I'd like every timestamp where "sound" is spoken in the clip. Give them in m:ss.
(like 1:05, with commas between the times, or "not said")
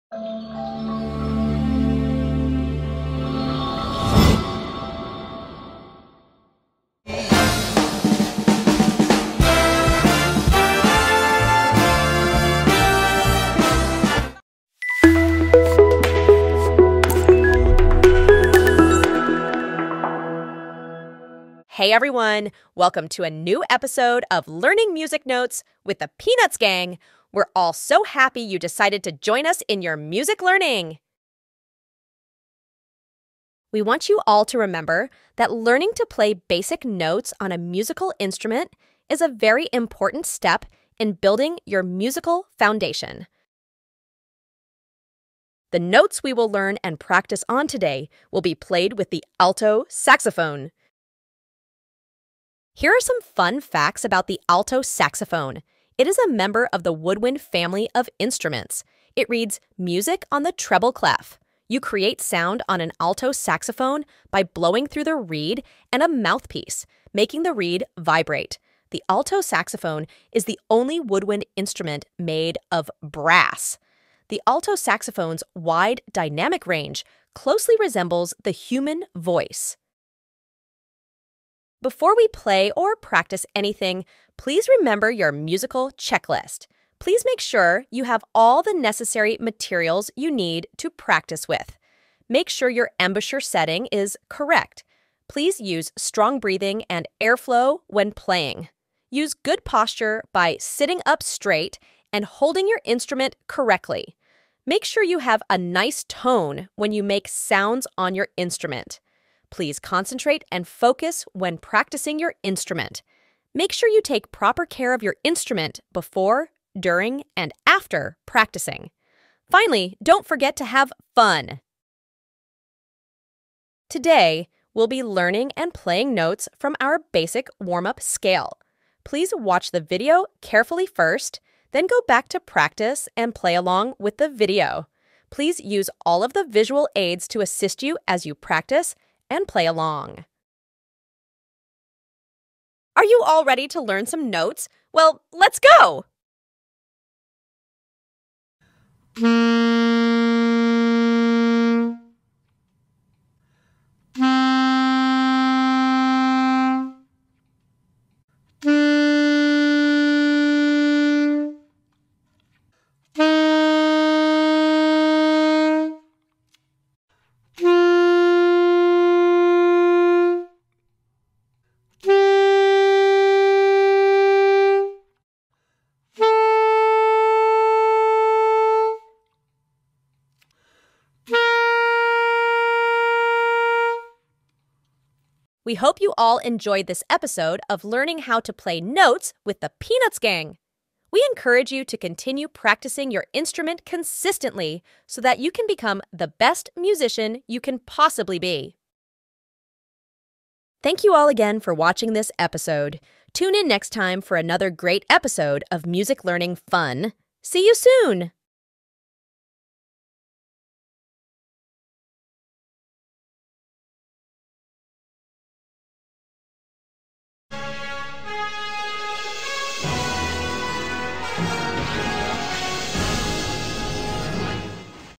1:02, 1:47.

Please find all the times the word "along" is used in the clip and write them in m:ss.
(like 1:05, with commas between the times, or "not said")
2:13, 2:19.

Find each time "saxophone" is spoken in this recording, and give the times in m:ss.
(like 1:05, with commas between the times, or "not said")
0:49, 0:54, 1:03, 1:09, 1:14.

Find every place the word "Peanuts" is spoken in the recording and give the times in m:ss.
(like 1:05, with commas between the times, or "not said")
0:26, 3:09.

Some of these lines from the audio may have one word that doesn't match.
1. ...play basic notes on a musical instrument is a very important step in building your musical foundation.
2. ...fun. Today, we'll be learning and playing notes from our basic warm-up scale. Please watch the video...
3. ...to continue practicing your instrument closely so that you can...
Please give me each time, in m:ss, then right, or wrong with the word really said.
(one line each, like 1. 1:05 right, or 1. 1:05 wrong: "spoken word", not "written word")
1. 0:36 right
2. 2:01 right
3. 3:11 wrong: "consistently", not "closely".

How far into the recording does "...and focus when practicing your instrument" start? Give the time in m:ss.
1:50.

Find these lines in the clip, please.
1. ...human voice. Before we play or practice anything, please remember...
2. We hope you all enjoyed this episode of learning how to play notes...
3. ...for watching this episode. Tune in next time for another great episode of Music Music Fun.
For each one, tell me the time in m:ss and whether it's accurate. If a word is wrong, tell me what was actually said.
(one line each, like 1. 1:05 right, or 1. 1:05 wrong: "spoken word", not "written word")
1. 1:18 right
2. 3:05 right
3. 3:21 wrong: "Learning", not "Music".